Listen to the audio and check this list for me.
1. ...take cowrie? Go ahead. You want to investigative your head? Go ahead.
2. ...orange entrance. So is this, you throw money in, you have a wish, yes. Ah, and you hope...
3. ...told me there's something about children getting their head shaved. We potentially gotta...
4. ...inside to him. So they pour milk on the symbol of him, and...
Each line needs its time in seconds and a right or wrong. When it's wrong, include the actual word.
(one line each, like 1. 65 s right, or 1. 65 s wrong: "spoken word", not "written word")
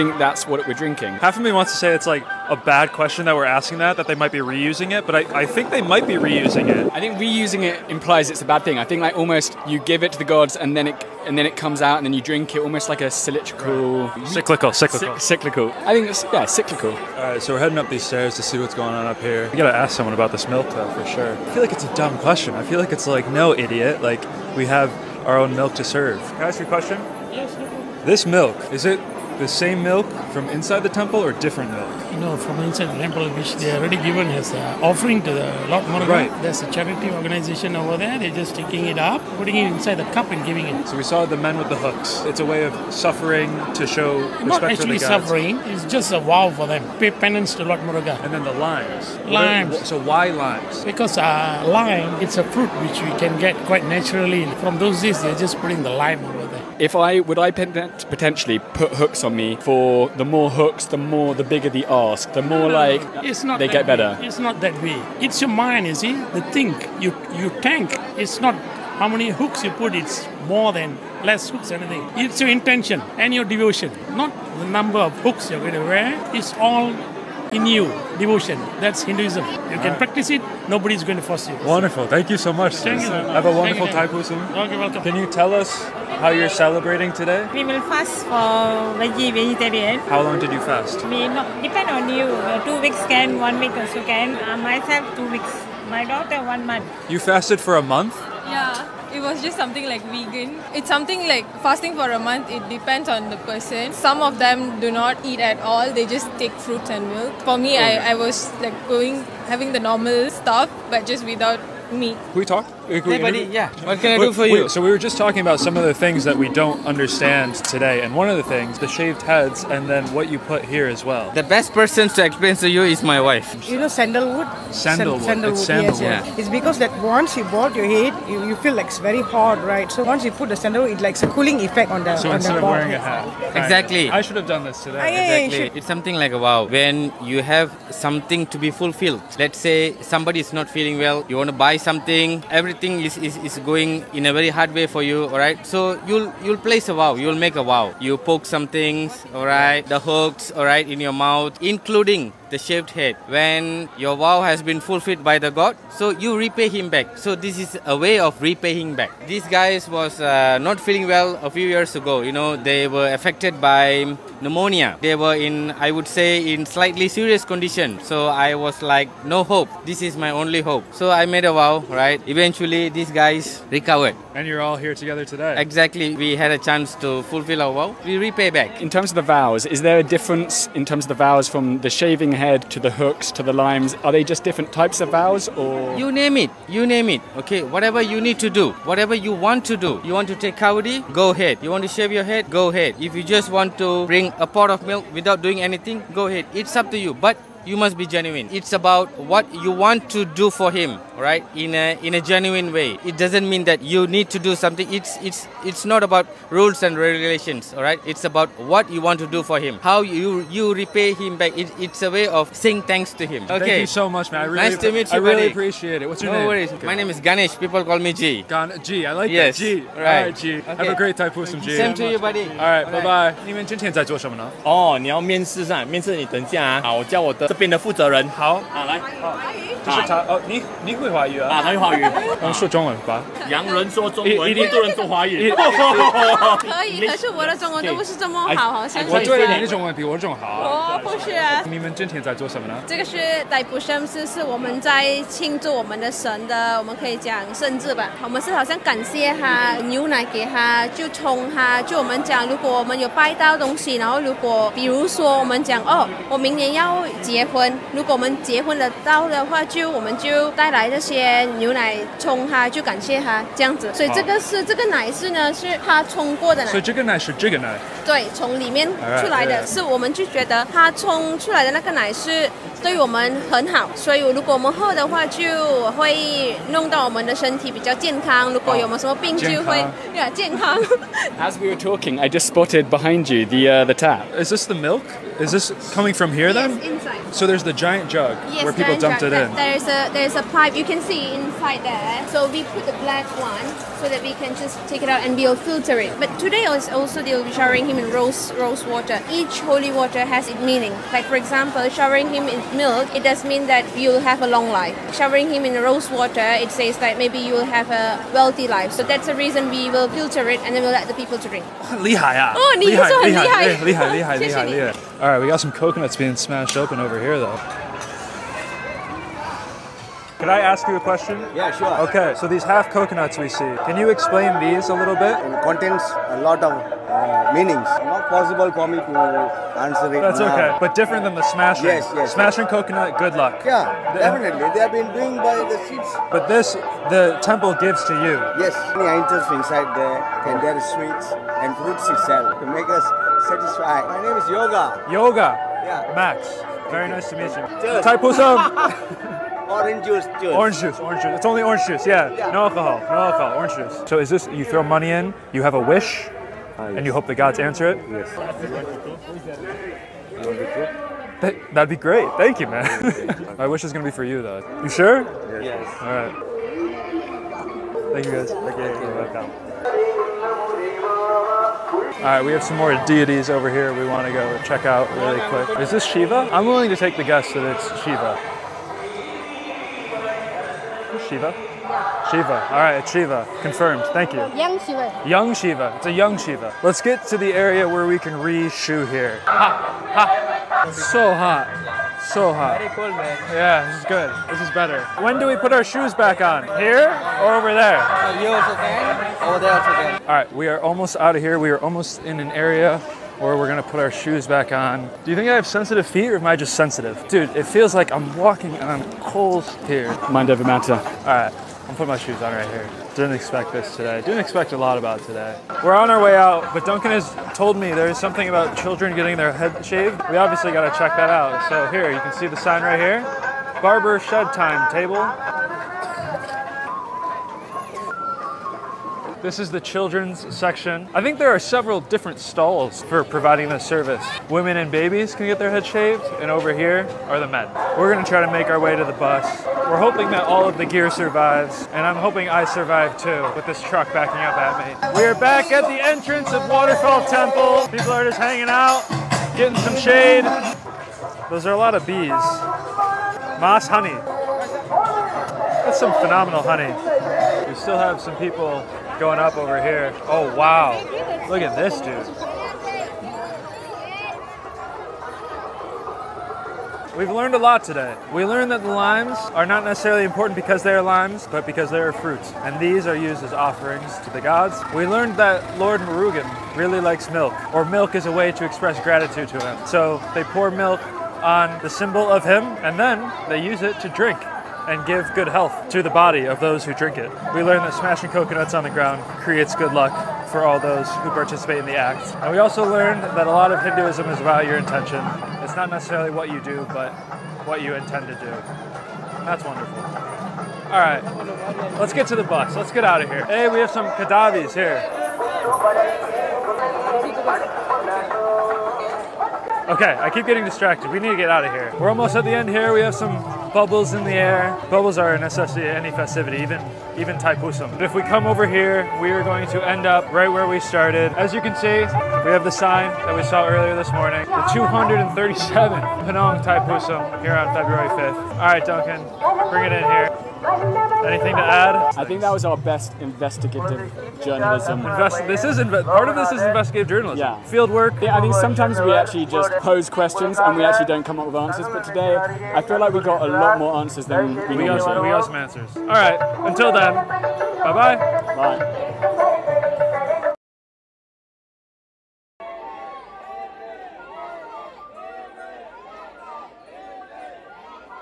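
1. 190 s wrong: "shave", not "investigative"
2. 353 s wrong: "juice", not "entrance"
3. 417 s wrong: "obviously", not "potentially"
4. 479 s wrong: "gratitude", not "inside".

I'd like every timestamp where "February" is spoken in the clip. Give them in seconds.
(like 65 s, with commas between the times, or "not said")
527 s.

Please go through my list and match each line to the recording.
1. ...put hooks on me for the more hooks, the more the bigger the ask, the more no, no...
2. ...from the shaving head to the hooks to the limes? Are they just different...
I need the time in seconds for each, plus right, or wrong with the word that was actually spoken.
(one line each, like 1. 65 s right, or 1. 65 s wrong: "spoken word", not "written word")
1. 58 s right
2. 181 s right.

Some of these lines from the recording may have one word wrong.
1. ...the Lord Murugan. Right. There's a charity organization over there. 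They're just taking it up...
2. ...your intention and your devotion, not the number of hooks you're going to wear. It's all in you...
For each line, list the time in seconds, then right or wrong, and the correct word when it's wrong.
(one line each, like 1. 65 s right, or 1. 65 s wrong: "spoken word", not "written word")
1. 35 s right
2. 72 s right.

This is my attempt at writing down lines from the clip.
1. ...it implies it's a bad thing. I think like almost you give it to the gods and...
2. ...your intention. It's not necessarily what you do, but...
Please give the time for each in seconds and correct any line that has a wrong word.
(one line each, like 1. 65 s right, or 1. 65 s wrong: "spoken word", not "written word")
1. 7 s right
2. 494 s right.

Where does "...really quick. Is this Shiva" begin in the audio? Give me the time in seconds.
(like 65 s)
375 s.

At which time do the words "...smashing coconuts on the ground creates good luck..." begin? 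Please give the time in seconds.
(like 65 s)
487 s.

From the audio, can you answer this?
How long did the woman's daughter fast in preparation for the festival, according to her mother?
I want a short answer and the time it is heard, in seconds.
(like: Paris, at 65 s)
One month, at 96 s.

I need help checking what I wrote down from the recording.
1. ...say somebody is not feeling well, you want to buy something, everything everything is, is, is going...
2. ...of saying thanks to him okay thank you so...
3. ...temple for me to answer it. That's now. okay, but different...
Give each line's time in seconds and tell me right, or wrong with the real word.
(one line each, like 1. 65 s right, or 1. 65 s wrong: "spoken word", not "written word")
1. 139 s right
2. 212 s right
3. 328 s wrong: "possible", not "temple".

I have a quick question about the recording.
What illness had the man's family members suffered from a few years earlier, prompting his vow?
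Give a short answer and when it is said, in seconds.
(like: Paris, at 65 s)
Pneumonia, at 164 s.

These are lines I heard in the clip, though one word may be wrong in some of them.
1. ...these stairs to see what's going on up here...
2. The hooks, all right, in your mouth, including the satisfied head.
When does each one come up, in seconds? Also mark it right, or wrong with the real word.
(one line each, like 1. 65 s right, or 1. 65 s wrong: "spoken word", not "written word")
1. 17 s right
2. 149 s wrong: "shaved", not "satisfied".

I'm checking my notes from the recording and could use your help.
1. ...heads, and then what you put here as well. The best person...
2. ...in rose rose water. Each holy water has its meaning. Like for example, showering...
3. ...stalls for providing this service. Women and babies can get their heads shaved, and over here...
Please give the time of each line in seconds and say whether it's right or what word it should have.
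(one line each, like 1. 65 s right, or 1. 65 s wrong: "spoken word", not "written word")
1. 119 s right
2. 297 s right
3. 432 s right.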